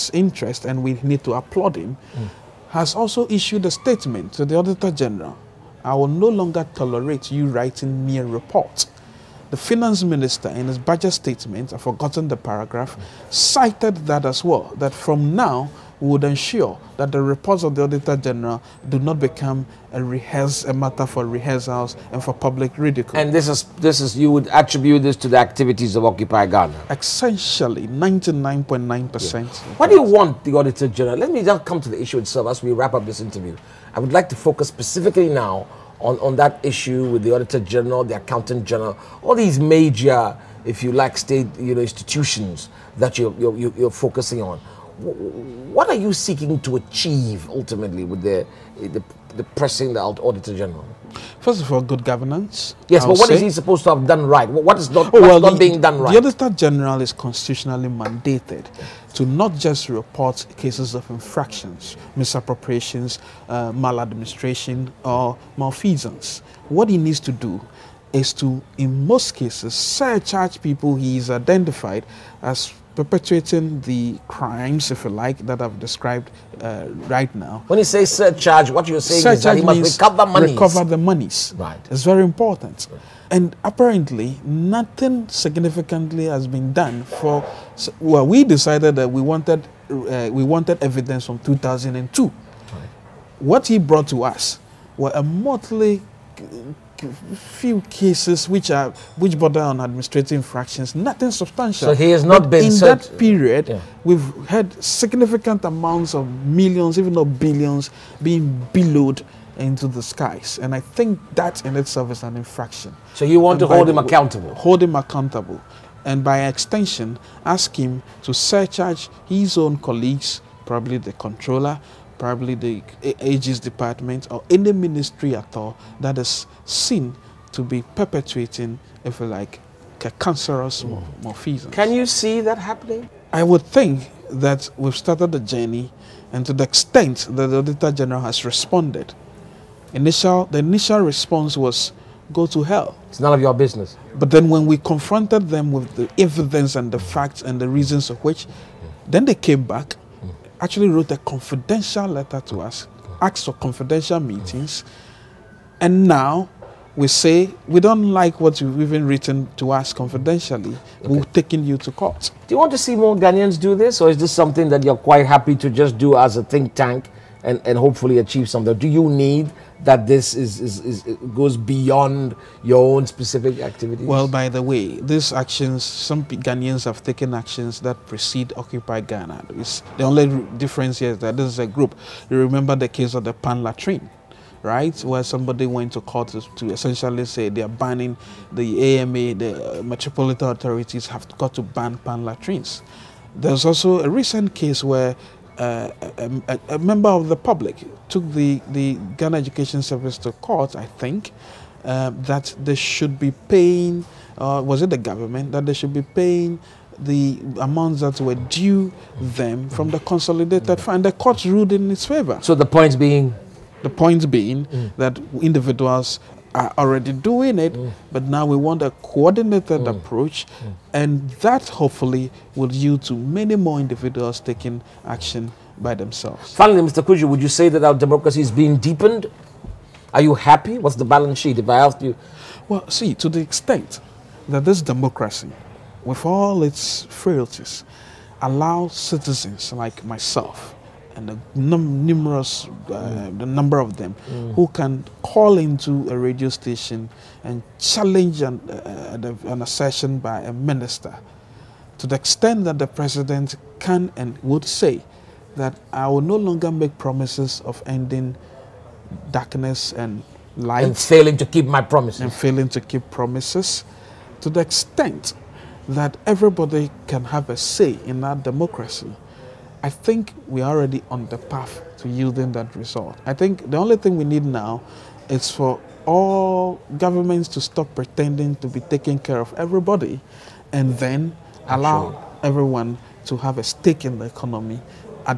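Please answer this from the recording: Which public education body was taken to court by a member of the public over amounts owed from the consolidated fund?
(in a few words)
Ghana Education Service.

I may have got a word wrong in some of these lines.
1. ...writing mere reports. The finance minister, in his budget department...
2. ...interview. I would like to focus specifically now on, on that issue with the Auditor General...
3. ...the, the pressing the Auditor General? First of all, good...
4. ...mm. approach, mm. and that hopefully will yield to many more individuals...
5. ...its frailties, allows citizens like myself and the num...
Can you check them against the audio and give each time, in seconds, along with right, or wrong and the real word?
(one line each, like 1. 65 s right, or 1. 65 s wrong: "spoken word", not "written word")
1. 7 s wrong: "statement", not "department"
2. 33 s right
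3. 48 s right
4. 219 s right
5. 236 s right.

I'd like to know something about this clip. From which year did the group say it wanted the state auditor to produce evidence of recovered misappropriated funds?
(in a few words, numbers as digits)
2002.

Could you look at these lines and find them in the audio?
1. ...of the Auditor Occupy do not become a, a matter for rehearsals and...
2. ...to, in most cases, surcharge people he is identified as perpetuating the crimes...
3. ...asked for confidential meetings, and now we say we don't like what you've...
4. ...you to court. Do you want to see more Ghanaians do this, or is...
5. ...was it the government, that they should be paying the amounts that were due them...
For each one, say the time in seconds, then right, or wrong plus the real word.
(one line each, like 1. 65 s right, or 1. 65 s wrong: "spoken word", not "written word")
1. 17 s wrong: "General", not "Occupy"
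2. 68 s right
3. 153 s right
4. 161 s right
5. 204 s right.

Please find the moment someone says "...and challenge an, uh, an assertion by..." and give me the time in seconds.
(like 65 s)
247 s.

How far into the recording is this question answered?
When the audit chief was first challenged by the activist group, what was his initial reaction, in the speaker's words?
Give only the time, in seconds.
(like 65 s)
142 s.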